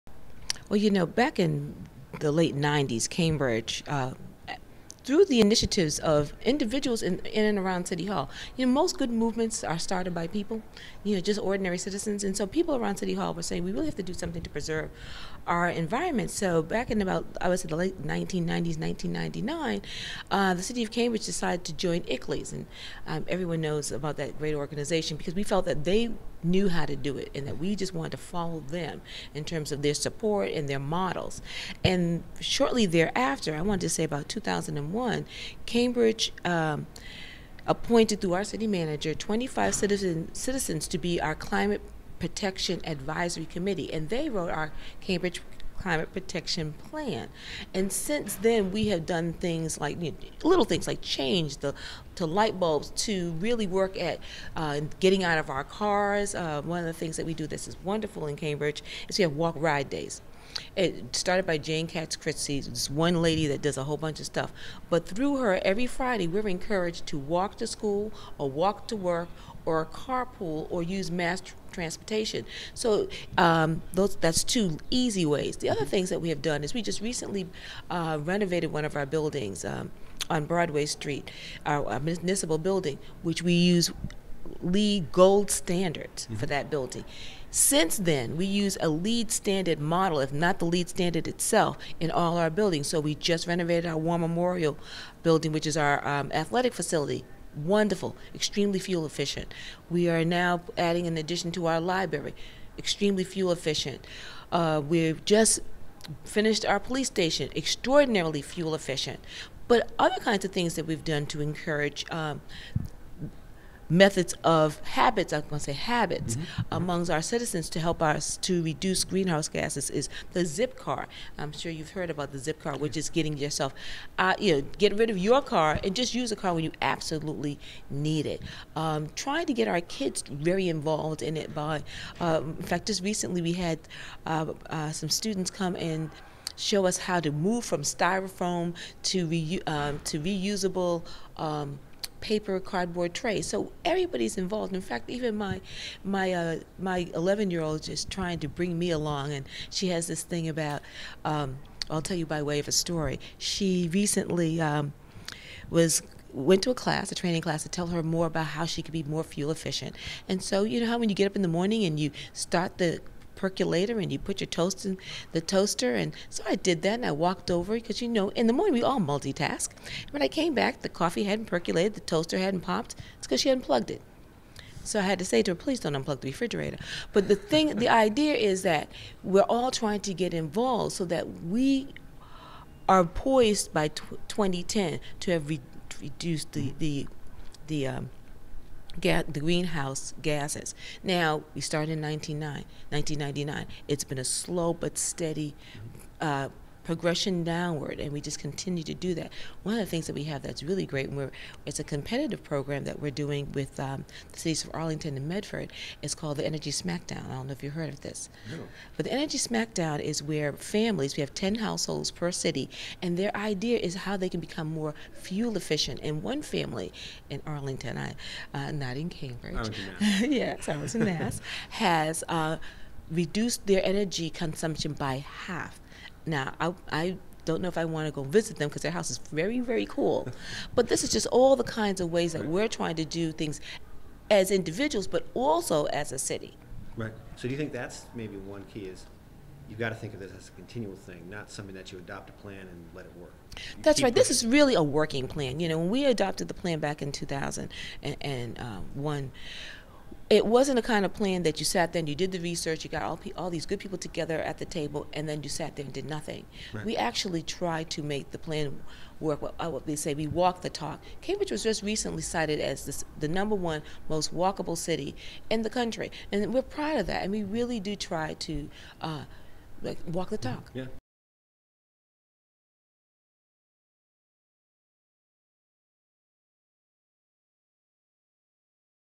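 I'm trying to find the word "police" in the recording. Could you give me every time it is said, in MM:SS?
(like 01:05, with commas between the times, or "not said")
01:46.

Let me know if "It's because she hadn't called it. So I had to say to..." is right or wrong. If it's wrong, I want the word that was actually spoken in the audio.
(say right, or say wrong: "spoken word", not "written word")
wrong: "plugged", not "called".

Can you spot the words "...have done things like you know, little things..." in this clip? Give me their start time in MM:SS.
00:48.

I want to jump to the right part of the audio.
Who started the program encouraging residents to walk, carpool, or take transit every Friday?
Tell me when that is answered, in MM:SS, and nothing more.
01:01.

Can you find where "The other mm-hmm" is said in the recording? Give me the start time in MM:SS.
01:15.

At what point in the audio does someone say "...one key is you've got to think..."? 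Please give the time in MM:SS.
03:58.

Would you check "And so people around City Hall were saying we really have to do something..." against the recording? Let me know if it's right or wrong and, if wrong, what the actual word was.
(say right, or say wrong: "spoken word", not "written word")
right.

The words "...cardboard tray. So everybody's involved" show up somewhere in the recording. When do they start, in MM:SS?
02:22.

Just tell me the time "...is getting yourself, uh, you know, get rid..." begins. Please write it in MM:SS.
02:02.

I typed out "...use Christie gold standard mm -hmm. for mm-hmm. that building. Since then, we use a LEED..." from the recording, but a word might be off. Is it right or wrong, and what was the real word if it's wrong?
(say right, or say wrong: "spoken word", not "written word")
wrong: "LEED", not "Christie".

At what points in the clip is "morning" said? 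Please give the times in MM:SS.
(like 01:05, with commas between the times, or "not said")
02:41, 02:48.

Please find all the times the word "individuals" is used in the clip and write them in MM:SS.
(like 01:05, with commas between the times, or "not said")
00:06, 03:54.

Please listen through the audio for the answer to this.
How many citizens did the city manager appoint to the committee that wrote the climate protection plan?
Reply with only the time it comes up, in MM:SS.
00:39.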